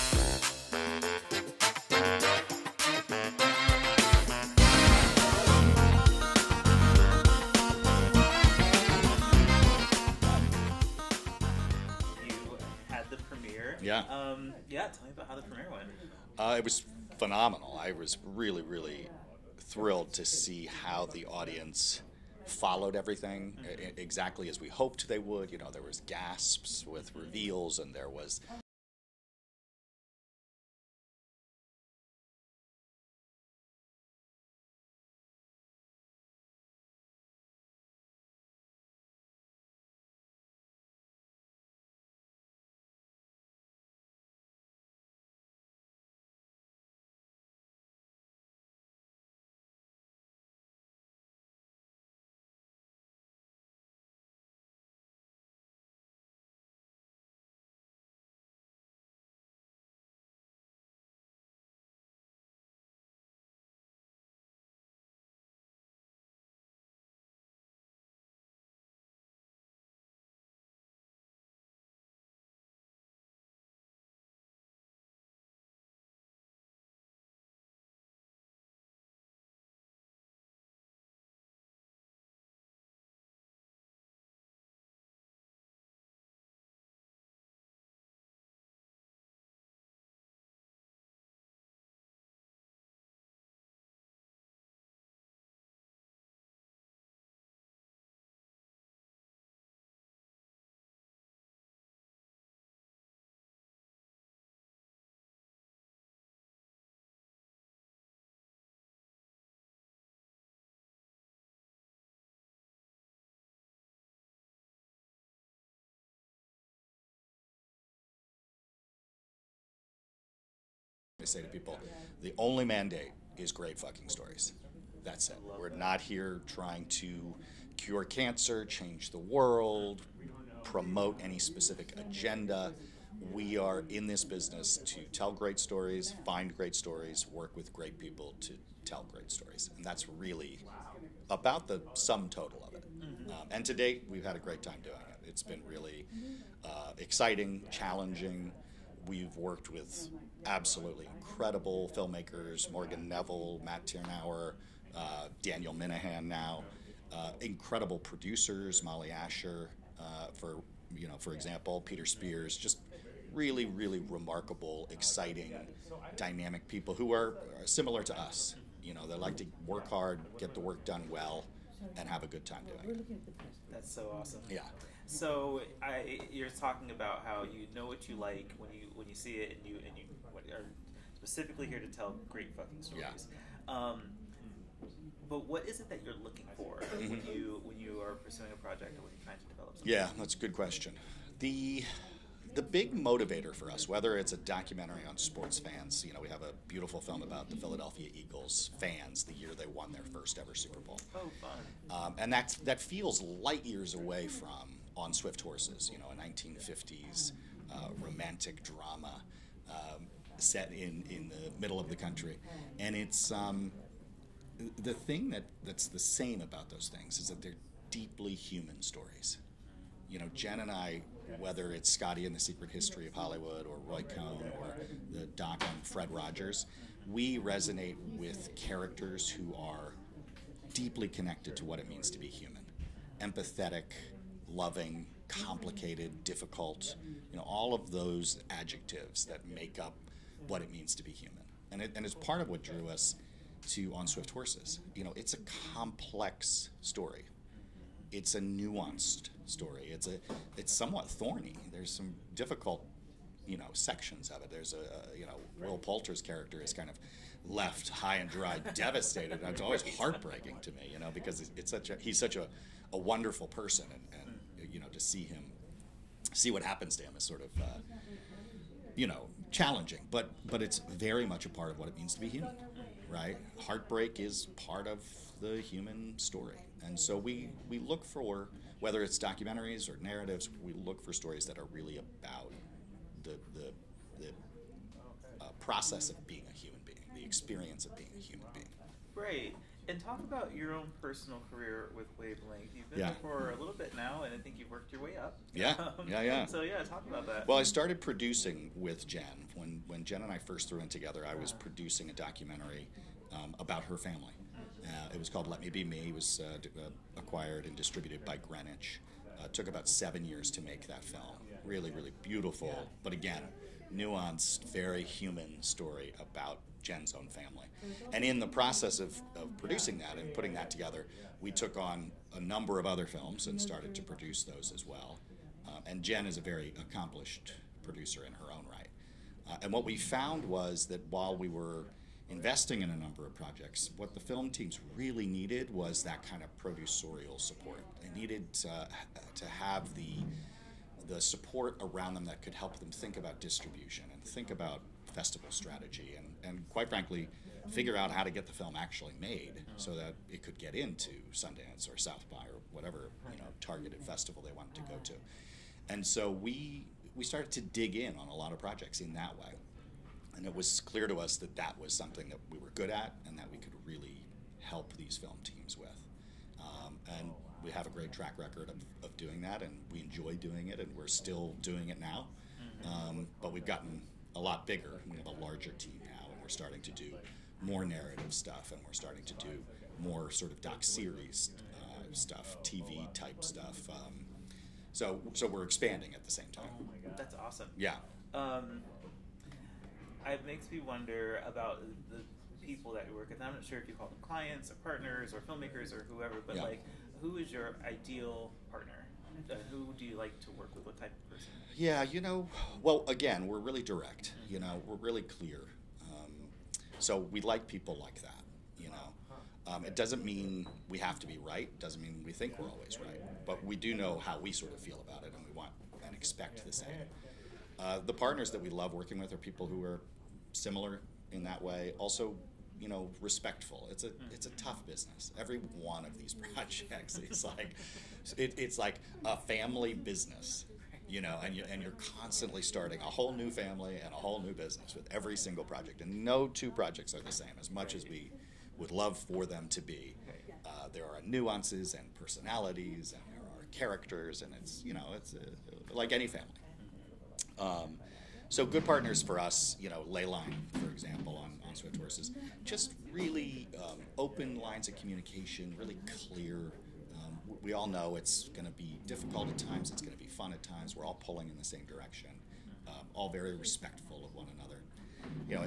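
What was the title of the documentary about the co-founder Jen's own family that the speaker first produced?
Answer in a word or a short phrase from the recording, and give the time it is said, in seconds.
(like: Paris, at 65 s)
Let Me Be Me, at 305 s.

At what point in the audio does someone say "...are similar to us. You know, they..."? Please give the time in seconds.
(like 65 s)
167 s.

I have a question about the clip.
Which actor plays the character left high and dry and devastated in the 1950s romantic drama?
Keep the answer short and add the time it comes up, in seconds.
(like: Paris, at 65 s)
Will Poulter, at 255 s.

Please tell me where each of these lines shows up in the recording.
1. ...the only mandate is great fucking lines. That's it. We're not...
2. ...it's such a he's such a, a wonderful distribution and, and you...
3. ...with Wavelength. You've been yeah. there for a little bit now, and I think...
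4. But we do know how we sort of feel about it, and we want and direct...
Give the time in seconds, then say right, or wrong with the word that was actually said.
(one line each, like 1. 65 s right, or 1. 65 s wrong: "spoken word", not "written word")
1. 122 s wrong: "stories", not "lines"
2. 261 s wrong: "person", not "distribution"
3. 291 s right
4. 413 s wrong: "expect", not "direct".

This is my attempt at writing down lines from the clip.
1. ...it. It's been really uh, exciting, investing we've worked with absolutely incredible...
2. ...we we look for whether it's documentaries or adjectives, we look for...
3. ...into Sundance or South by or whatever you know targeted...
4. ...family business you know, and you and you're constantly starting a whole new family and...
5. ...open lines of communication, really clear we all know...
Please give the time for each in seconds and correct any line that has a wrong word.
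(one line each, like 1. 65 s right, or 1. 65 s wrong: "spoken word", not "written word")
1. 145 s wrong: "challenging", not "investing"
2. 277 s wrong: "narratives", not "adjectives"
3. 350 s right
4. 429 s right
5. 454 s right.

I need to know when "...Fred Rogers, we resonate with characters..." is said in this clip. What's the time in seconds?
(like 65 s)
225 s.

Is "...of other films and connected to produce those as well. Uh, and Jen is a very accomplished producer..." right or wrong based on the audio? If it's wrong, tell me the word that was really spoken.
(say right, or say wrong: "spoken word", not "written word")
wrong: "started", not "connected".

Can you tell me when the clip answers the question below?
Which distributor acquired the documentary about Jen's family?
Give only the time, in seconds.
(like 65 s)
308 s.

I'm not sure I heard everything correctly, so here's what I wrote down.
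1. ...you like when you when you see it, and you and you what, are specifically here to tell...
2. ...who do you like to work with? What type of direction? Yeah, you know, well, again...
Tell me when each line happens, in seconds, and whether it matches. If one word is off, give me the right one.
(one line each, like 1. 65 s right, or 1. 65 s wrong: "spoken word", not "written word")
1. 178 s right
2. 399 s wrong: "person", not "direction".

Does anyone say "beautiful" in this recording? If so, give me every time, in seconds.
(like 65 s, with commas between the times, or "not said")
196 s, 312 s.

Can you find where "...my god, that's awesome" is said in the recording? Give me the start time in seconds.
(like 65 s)
386 s.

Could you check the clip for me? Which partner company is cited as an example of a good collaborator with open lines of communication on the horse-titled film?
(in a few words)
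Leyline.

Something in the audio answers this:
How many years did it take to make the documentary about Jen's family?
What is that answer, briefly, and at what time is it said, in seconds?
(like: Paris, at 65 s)
7, at 309 s.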